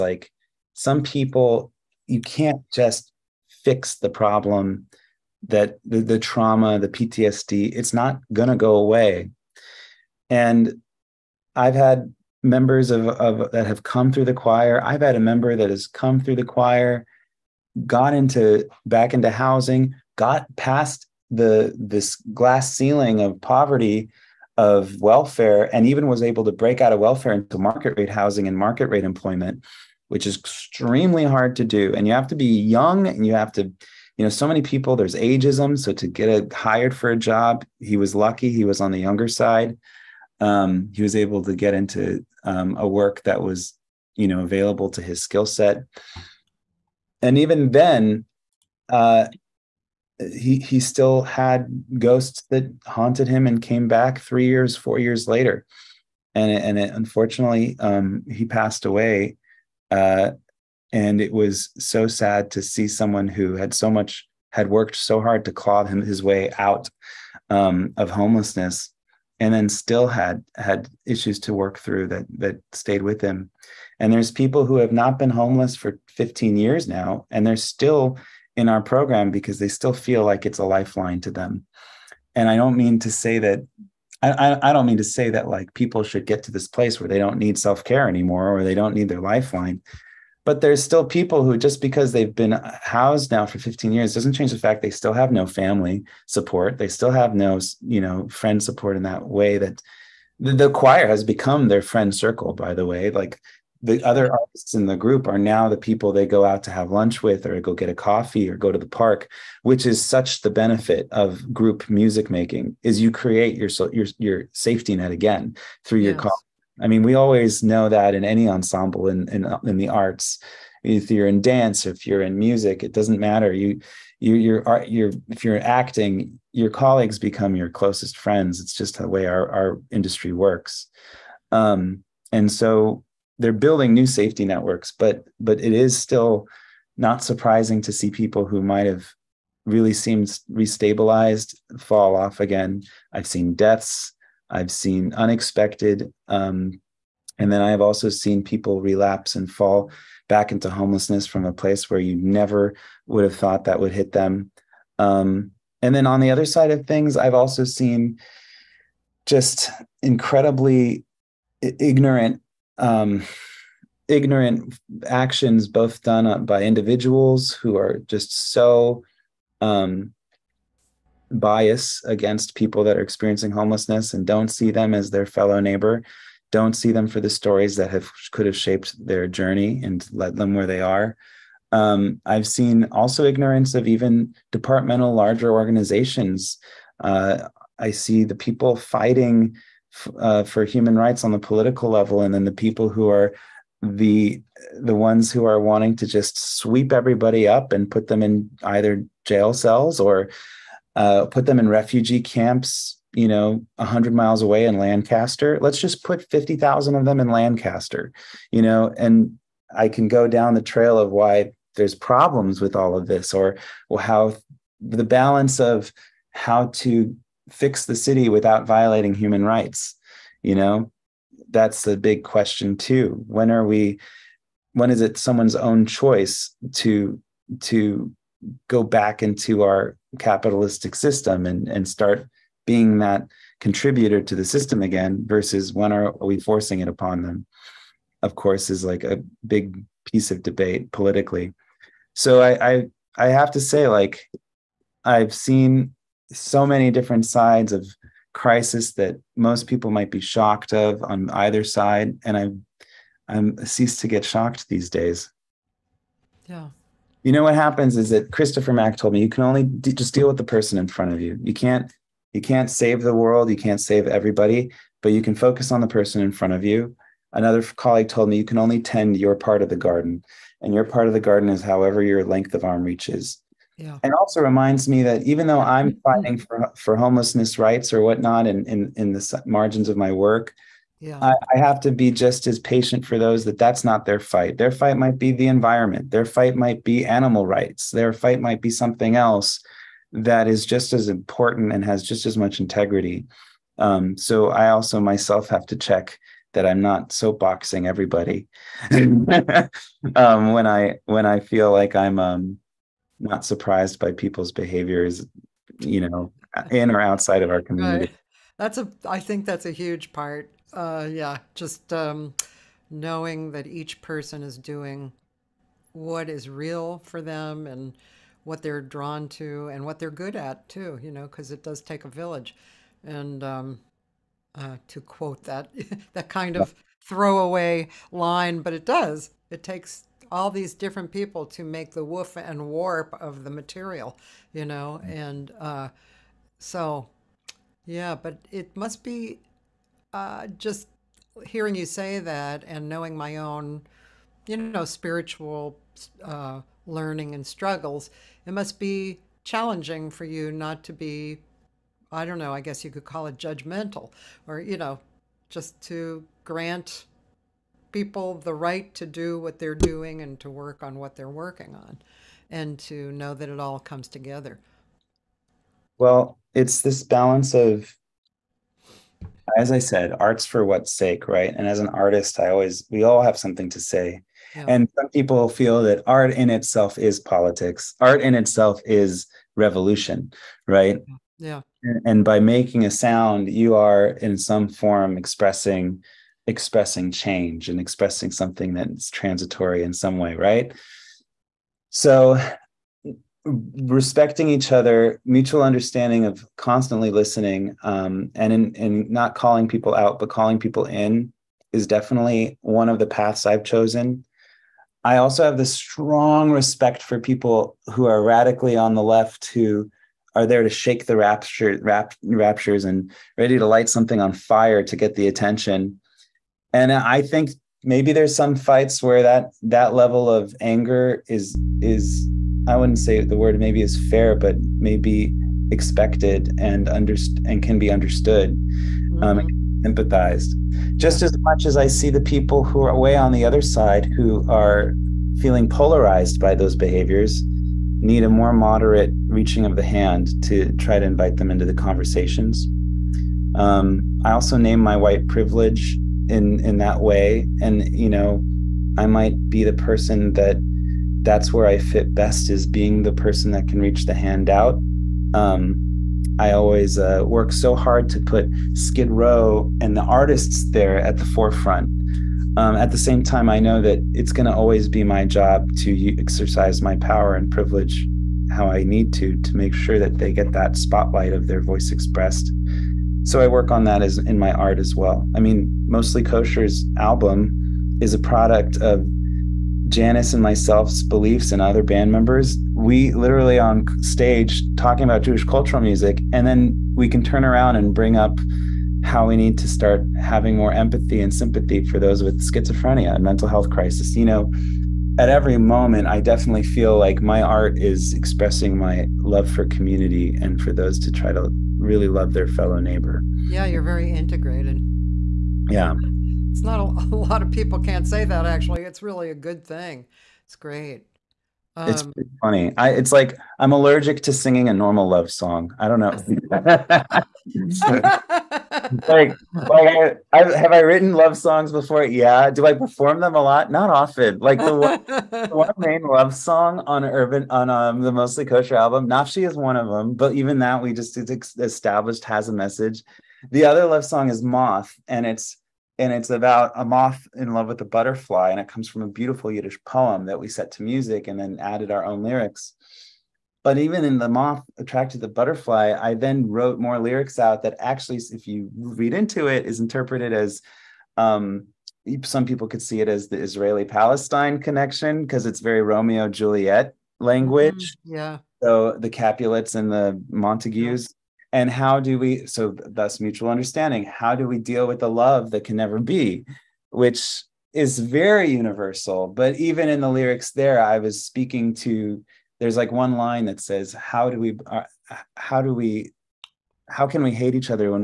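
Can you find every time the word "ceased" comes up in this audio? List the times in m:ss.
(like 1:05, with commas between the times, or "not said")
4:13.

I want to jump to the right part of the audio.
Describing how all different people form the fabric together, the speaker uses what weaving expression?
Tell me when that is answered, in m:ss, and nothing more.
5:32.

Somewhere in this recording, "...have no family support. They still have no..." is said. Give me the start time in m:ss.
1:35.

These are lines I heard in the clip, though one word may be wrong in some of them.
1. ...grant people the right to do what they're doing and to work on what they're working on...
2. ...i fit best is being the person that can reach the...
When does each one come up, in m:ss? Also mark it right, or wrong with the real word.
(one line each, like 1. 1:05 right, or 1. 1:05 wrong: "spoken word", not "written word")
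1. 5:56 right
2. 7:31 right.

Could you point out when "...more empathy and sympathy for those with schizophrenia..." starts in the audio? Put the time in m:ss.
8:10.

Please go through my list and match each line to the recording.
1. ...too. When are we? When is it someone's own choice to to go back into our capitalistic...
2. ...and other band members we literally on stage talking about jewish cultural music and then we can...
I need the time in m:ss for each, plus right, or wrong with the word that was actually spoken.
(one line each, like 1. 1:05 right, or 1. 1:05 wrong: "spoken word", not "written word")
1. 3:42 right
2. 8:01 right.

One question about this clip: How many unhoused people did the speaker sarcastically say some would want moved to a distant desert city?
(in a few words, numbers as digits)
50000.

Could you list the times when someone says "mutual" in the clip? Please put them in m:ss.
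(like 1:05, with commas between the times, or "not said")
6:35, 9:23.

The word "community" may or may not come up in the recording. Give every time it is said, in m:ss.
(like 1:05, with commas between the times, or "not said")
5:07, 8:19.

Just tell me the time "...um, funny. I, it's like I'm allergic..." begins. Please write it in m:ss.
8:32.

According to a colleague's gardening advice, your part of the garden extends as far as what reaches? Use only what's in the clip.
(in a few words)
length of arm.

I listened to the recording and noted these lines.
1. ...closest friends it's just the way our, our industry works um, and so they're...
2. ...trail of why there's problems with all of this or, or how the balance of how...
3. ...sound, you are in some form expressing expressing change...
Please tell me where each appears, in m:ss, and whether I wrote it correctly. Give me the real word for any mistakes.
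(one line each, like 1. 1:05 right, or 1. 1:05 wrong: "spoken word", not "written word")
1. 2:07 right
2. 3:30 right
3. 6:22 right.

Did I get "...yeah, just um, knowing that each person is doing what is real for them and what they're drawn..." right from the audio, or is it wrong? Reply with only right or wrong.
right.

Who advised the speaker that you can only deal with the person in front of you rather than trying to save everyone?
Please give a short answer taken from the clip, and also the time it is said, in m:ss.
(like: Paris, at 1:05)
Christopher Mack, at 4:18.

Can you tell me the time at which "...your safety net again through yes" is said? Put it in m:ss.
1:54.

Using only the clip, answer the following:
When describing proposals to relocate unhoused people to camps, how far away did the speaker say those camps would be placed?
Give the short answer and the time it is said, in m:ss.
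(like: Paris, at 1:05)
100 miles, at 3:23.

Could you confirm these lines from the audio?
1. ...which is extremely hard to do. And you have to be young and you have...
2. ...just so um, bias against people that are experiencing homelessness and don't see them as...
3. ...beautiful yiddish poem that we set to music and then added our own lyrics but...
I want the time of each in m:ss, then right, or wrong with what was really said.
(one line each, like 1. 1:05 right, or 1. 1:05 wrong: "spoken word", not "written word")
1. 0:30 right
2. 2:48 right
3. 8:59 right.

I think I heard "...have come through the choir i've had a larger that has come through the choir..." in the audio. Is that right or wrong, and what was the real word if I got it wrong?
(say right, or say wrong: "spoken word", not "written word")
wrong: "member", not "larger".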